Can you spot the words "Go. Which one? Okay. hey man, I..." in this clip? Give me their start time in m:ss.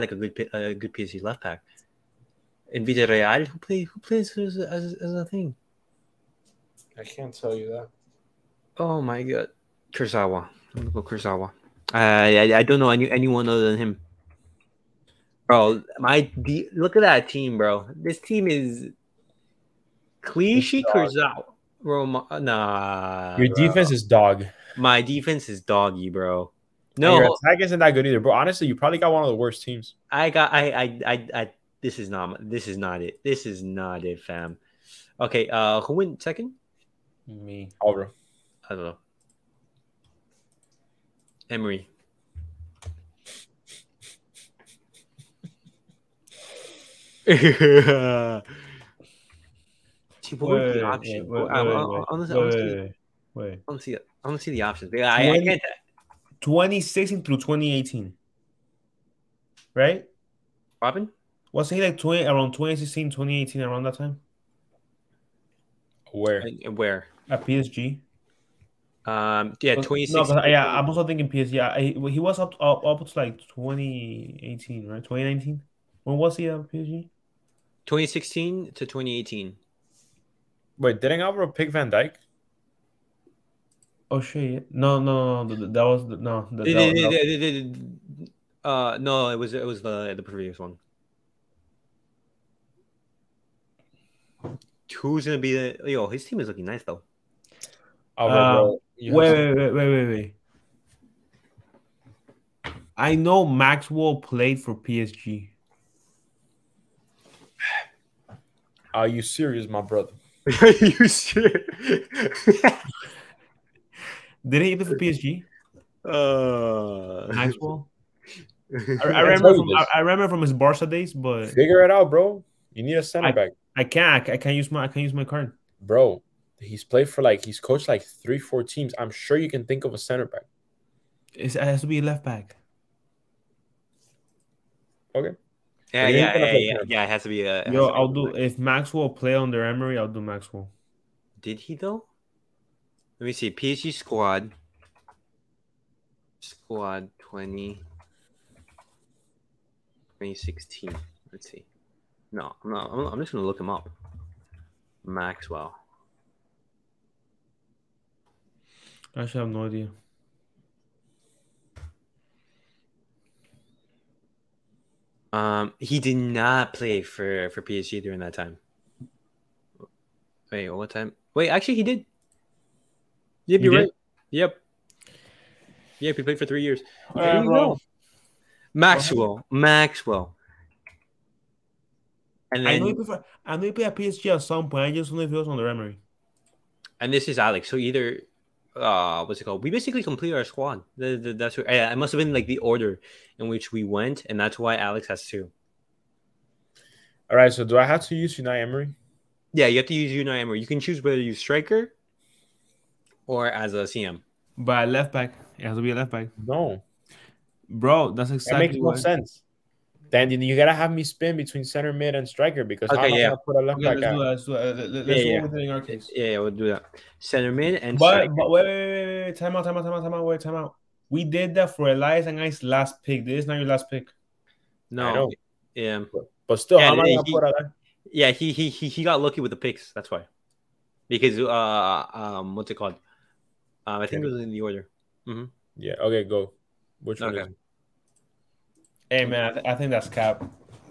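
3:56.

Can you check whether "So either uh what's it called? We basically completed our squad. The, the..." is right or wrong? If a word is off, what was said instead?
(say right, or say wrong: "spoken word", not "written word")
right.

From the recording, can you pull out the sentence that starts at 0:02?
In Villarreal, who play who plays as, as, as a thing?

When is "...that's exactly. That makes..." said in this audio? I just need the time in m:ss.
3:28.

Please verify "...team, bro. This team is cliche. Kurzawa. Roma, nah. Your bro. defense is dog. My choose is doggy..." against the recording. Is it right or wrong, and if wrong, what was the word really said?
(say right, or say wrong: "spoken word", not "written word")
wrong: "defense", not "choose".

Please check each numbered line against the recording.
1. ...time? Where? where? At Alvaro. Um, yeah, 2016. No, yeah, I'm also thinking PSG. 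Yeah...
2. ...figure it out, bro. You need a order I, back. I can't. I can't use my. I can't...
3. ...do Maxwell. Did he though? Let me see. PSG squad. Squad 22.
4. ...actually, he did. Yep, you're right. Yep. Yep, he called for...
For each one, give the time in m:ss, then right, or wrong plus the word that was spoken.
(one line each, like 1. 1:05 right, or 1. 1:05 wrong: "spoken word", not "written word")
1. 1:03 wrong: "PSG", not "Alvaro"
2. 2:01 wrong: "center", not "order"
3. 2:20 wrong: "20", not "22"
4. 2:51 wrong: "played", not "called".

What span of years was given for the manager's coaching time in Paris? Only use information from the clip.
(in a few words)
2016 through 2018.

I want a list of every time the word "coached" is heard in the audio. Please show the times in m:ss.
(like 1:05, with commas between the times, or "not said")
2:07.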